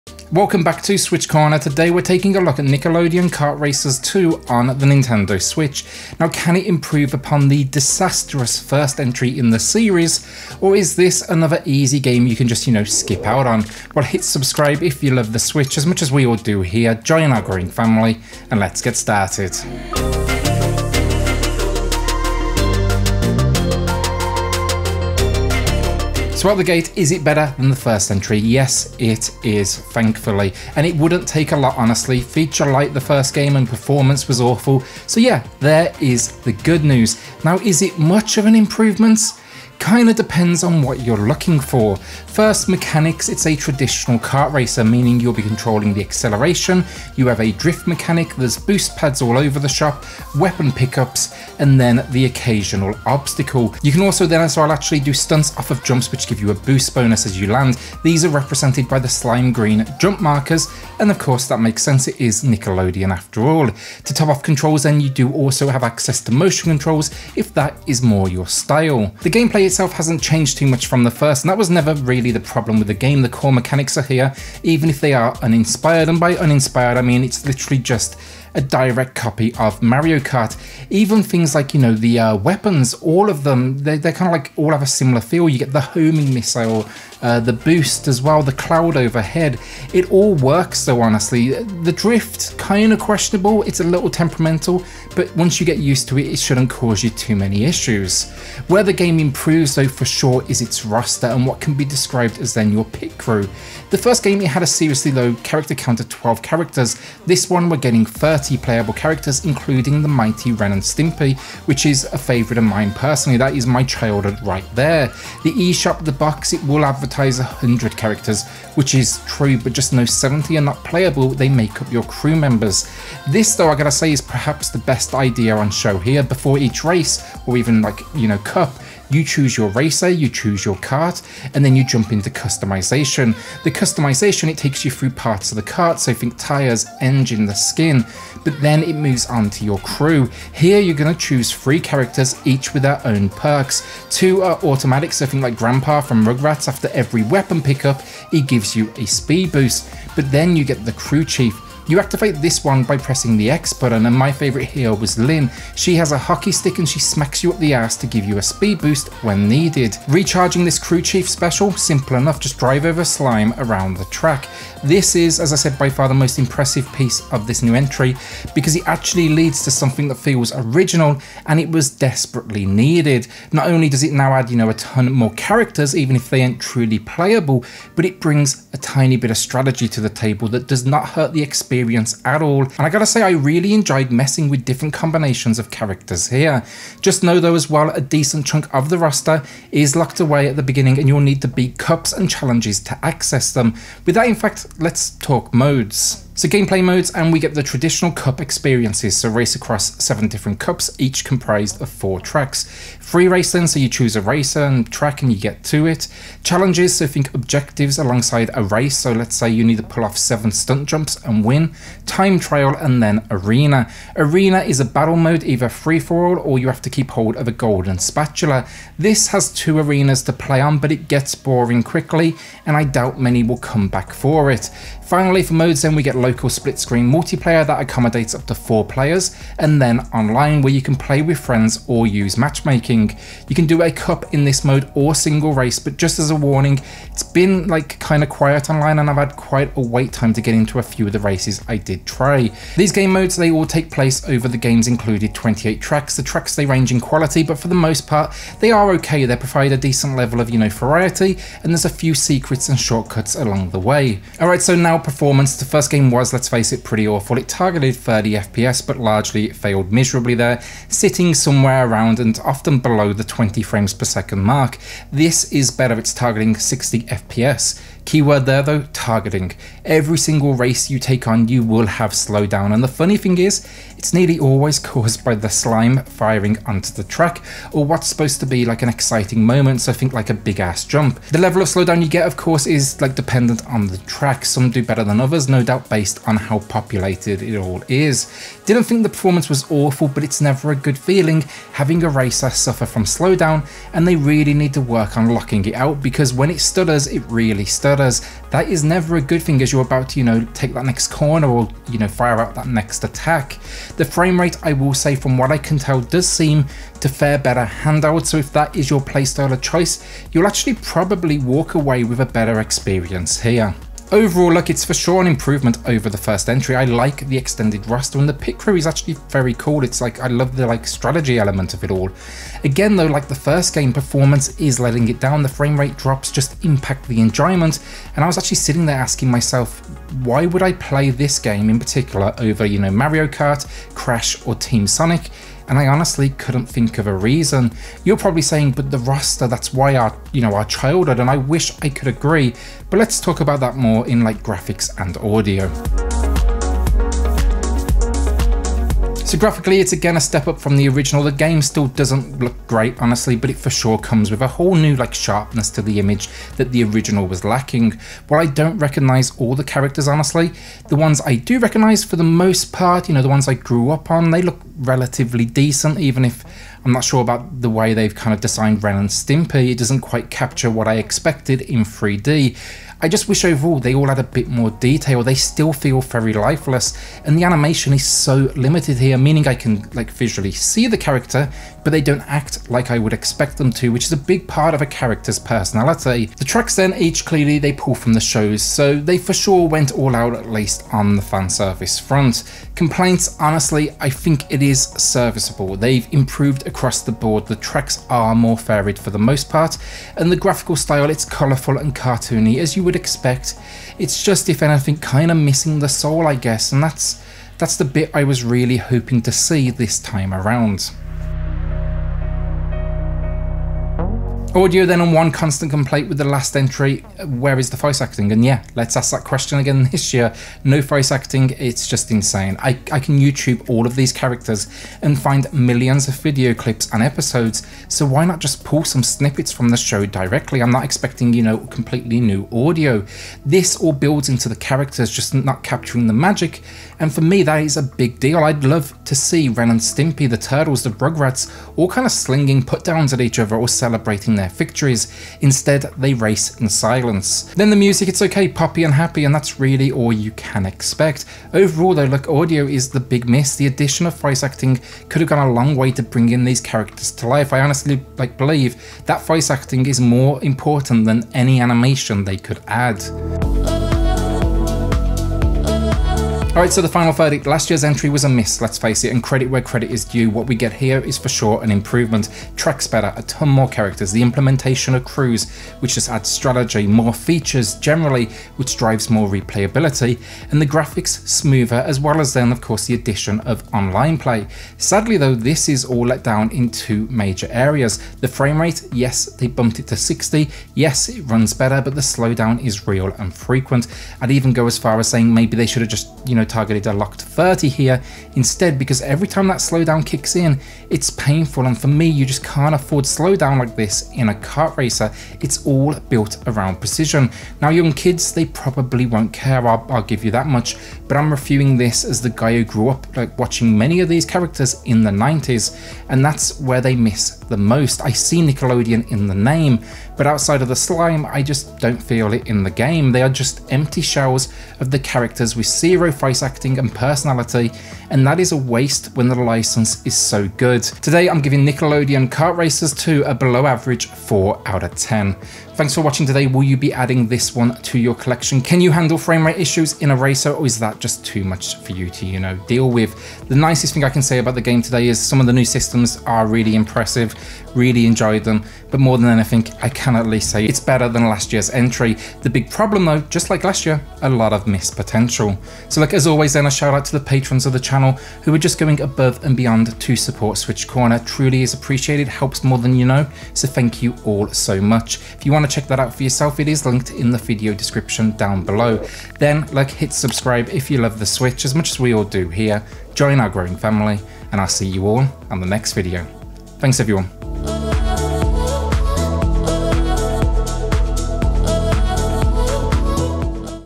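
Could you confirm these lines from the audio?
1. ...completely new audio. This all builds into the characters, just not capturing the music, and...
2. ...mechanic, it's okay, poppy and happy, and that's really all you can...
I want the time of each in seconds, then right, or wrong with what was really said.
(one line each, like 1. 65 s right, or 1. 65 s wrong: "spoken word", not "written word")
1. 431 s wrong: "magic", not "music"
2. 447 s wrong: "music", not "mechanic".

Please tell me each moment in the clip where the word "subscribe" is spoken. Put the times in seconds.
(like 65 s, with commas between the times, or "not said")
14 s, 570 s.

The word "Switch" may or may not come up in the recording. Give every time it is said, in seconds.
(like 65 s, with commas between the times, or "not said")
0 s, 5 s, 15 s, 560 s, 571 s.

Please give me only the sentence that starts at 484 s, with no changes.
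Sadly, though, this is all let down in two major areas.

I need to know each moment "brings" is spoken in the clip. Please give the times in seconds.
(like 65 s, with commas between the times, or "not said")
178 s, 456 s.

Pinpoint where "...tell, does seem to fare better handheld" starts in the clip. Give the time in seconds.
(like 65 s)
305 s.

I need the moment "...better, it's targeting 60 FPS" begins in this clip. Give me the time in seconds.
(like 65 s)
265 s.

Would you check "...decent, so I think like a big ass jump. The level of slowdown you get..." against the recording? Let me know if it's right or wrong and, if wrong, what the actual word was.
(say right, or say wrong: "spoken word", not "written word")
wrong: "moment", not "decent".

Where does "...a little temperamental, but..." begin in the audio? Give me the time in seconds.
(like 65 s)
93 s.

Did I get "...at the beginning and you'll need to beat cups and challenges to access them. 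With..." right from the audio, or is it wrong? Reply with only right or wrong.
right.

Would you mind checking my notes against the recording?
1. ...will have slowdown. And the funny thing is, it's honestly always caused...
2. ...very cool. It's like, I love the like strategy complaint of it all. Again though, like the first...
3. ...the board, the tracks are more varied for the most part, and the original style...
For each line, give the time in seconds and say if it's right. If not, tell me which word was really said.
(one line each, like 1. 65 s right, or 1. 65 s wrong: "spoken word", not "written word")
1. 271 s wrong: "nearly", not "honestly"
2. 319 s wrong: "element", not "complaint"
3. 397 s wrong: "graphical", not "original".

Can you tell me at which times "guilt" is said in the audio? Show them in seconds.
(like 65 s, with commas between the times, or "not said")
not said.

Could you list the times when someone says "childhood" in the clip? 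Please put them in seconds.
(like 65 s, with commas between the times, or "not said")
113 s, 340 s.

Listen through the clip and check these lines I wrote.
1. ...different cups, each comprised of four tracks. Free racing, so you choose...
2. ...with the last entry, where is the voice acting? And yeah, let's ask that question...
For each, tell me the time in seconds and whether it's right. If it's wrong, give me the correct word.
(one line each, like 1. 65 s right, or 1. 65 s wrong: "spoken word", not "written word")
1. 200 s right
2. 416 s right.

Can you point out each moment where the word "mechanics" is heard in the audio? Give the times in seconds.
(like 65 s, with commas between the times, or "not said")
42 s, 47 s, 73 s.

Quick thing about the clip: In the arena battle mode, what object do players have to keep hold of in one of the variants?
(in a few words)
golden spatula.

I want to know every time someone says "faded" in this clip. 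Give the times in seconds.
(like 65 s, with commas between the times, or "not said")
not said.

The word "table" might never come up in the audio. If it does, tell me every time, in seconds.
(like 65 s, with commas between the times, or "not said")
180 s.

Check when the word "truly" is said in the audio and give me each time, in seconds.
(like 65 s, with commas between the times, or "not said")
176 s, 561 s.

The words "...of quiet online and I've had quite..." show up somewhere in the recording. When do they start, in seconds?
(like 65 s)
238 s.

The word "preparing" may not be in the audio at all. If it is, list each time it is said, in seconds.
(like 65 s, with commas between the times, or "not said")
not said.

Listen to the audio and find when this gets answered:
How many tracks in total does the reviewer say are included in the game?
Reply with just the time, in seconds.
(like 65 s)
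245 s.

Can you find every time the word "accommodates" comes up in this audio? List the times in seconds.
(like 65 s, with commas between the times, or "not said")
227 s.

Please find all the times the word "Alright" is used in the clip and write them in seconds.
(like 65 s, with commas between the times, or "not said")
466 s.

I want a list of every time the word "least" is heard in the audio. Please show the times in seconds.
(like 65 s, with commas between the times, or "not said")
390 s, 550 s.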